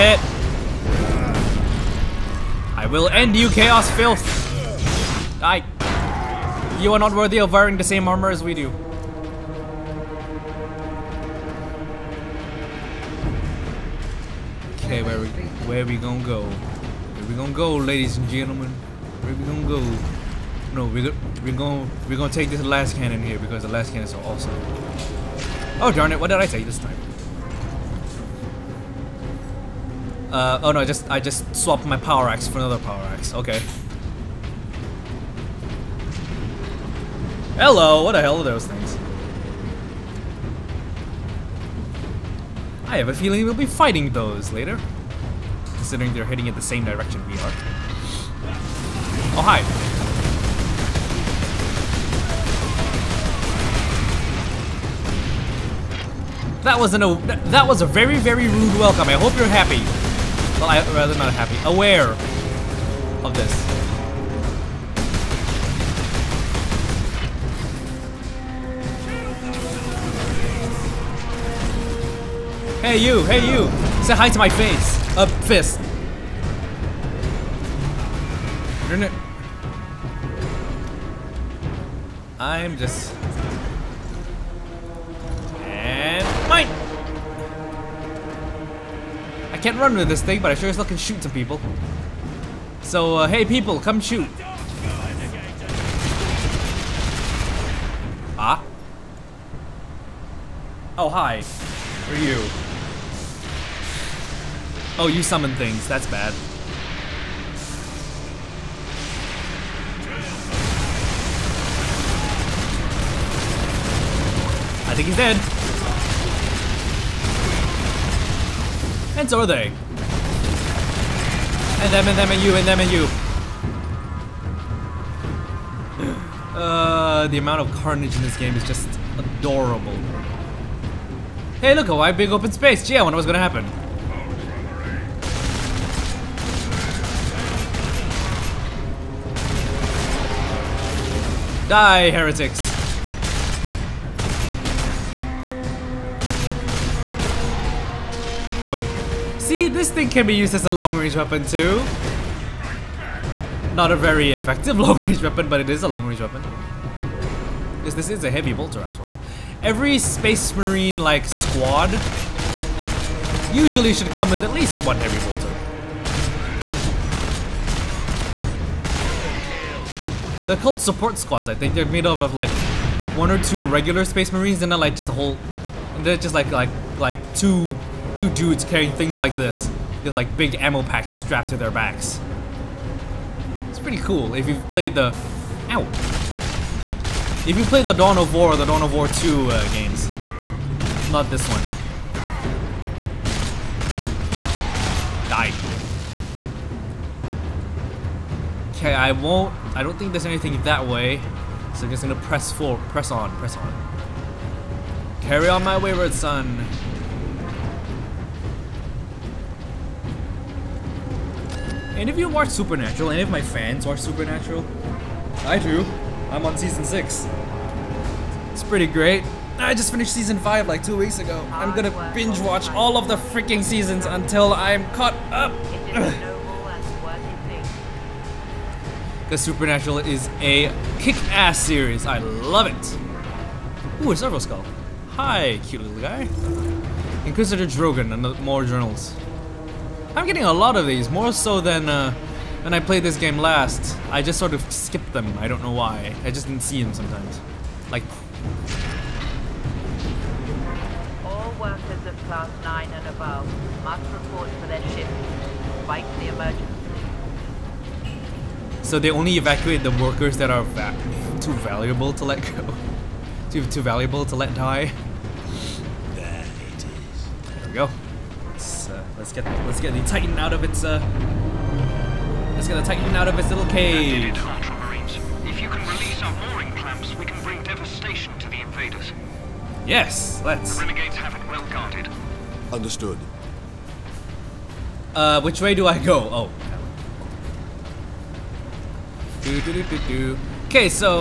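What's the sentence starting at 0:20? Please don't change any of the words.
No, we're we're gonna we're gonna take this lascannon here because the lascannons so awesome.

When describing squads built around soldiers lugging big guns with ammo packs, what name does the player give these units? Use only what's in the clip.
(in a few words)
support squads.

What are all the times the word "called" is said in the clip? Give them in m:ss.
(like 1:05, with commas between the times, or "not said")
2:50.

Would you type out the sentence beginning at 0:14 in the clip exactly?
Okay, where we, where we gonna go?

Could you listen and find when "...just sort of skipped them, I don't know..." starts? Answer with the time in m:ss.
4:04.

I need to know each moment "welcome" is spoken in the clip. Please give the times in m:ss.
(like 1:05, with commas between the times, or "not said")
0:58.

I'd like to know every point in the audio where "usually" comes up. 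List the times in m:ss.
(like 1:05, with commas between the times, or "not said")
2:43.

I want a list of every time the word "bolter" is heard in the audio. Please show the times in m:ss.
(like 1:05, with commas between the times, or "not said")
2:38, 2:45.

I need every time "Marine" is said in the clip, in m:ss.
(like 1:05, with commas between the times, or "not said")
2:40, 2:54.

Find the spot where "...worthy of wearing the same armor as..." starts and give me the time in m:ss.
0:07.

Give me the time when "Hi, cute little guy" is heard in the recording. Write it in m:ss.
3:55.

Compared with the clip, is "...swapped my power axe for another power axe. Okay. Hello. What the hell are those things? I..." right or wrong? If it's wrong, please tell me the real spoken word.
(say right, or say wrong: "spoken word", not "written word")
right.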